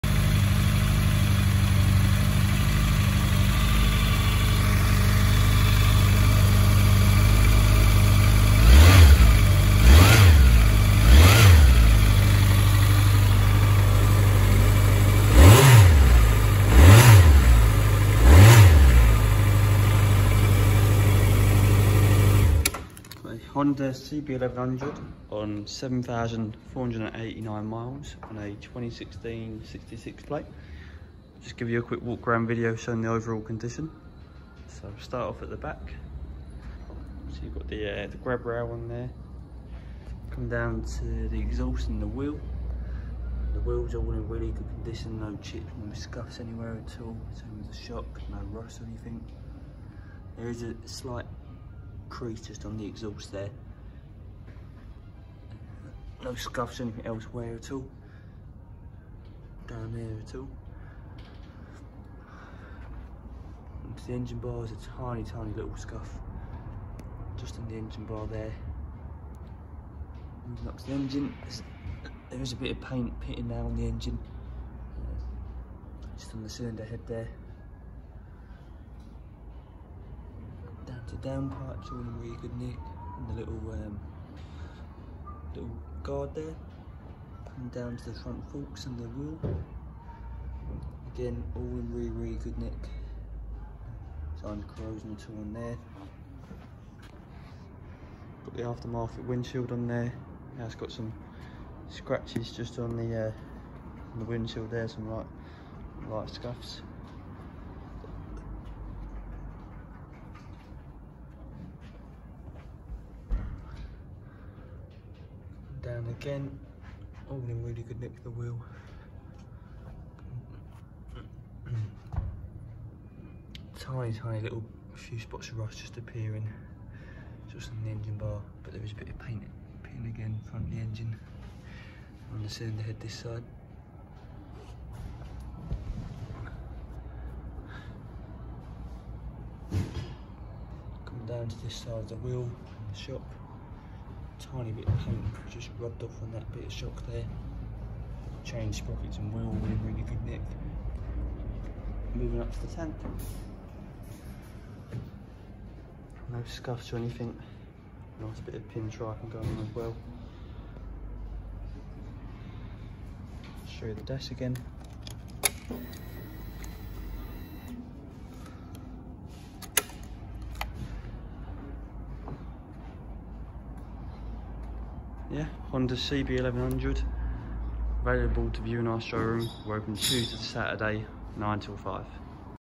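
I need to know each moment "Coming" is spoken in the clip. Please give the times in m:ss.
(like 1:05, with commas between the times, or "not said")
2:21.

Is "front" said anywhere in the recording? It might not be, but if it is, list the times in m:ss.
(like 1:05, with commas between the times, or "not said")
1:28, 2:10.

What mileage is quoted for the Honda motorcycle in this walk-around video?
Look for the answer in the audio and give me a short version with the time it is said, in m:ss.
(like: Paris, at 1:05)
7,489 miles, at 0:25.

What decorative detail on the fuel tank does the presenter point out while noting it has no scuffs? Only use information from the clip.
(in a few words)
pin striping.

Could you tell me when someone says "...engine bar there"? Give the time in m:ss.
1:07.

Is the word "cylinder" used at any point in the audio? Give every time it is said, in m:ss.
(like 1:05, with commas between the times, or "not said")
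1:16, 2:12.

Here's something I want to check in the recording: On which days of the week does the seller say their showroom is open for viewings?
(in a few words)
Tuesday to Saturday.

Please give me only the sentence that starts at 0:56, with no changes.
No scuffs anything elsewhere at all.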